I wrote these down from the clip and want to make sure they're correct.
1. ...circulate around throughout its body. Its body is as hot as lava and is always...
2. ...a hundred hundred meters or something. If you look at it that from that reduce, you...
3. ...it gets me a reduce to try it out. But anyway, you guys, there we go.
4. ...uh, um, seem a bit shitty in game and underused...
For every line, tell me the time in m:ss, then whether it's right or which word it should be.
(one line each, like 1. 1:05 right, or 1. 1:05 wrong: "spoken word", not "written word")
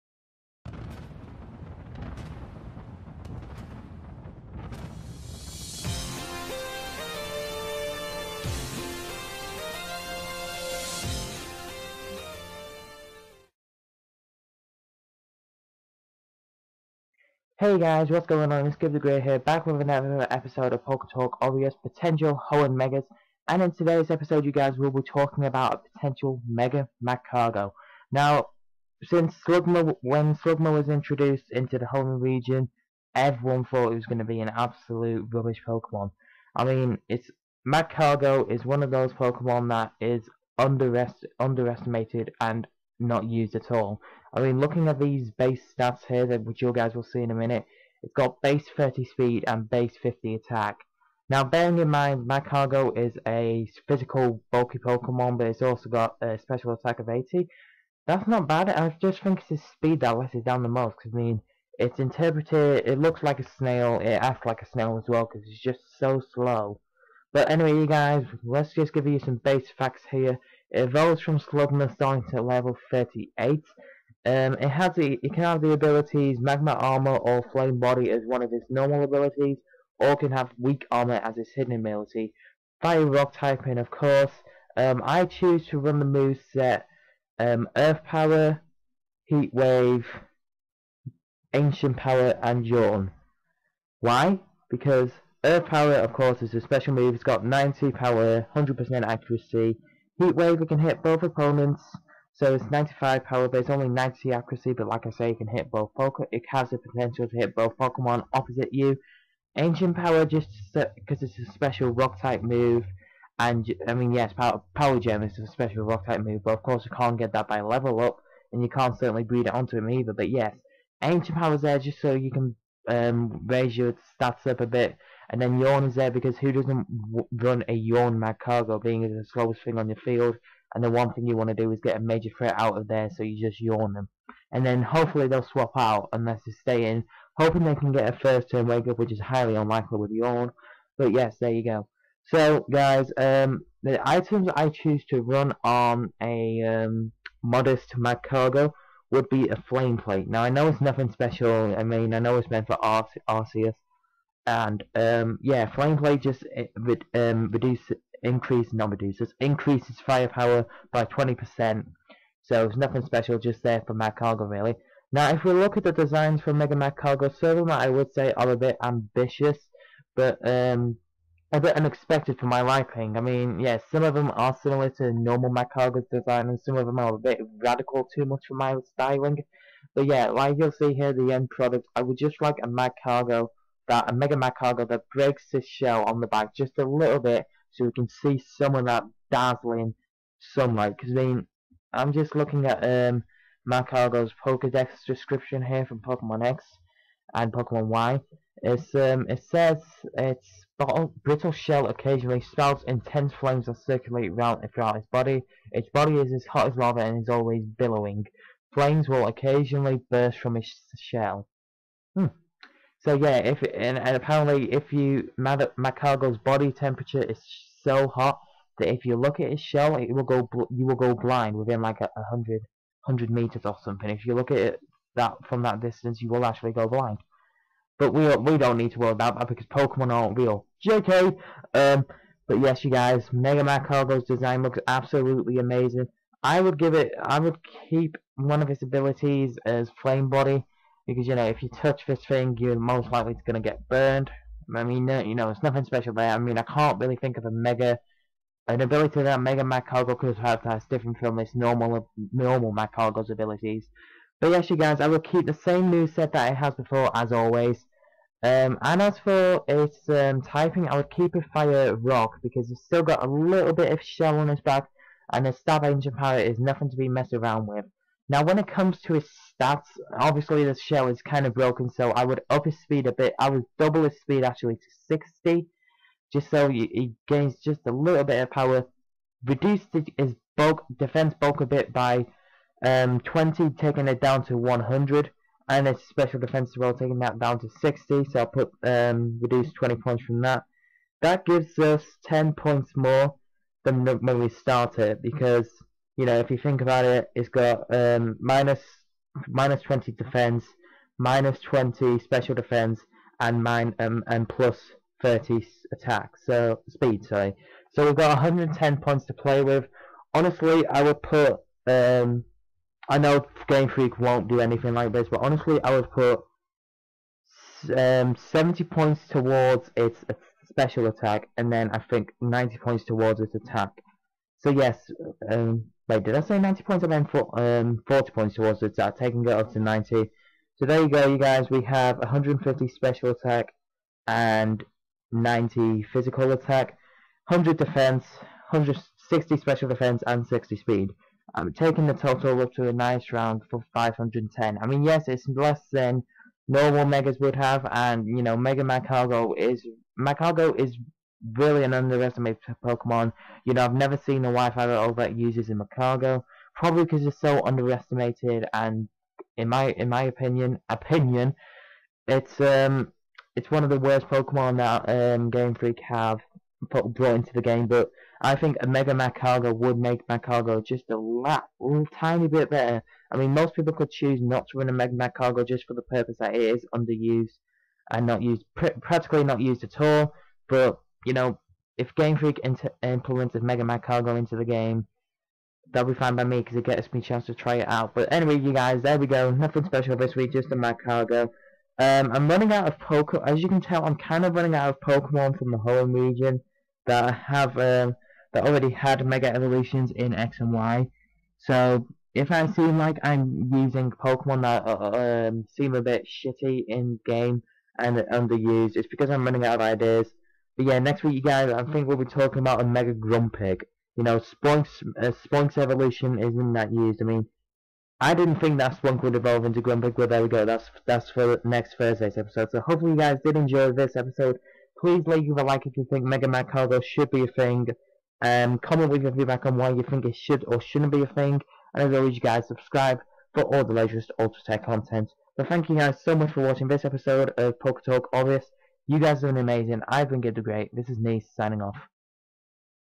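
1. 3:23 right
2. 3:42 wrong: "distance", not "reduce"
3. 6:26 wrong: "chance", not "reduce"
4. 6:44 right.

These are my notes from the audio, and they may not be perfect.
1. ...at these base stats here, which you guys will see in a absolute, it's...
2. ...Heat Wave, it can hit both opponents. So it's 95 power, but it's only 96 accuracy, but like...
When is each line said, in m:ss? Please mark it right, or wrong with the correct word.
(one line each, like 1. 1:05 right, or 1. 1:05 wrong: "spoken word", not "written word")
1. 0:44 wrong: "minute", not "absolute"
2. 1:40 wrong: "90", not "96".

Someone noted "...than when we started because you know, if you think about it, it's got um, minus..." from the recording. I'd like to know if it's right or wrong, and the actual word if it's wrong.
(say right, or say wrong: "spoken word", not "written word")
right.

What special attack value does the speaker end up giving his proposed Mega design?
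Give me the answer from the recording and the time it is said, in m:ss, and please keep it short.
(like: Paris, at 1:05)
150, at 5:32.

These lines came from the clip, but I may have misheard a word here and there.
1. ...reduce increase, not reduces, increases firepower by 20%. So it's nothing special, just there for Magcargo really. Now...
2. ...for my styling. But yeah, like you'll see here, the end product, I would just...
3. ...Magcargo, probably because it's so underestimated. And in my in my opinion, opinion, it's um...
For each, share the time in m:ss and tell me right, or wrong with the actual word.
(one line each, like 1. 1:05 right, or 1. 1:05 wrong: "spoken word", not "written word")
1. 2:37 right
2. 2:58 right
3. 5:55 right.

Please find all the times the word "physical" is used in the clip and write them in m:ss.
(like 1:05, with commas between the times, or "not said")
0:53, 5:36.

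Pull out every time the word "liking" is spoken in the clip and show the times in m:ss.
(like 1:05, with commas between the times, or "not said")
2:52.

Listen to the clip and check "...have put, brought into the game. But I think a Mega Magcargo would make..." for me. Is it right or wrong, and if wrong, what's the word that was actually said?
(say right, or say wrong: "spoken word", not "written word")
right.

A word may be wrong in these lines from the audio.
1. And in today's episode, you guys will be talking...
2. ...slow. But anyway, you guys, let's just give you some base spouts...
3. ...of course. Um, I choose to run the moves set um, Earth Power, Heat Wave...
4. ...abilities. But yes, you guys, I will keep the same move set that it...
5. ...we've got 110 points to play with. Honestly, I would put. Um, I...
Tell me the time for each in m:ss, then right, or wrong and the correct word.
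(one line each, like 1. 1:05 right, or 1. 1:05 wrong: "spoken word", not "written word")
1. 0:23 right
2. 1:06 wrong: "facts", not "spouts"
3. 1:23 right
4. 4:13 right
5. 5:08 right.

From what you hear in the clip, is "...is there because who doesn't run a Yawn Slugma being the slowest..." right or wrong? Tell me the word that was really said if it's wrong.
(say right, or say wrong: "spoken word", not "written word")
wrong: "Magcargo", not "Slugma".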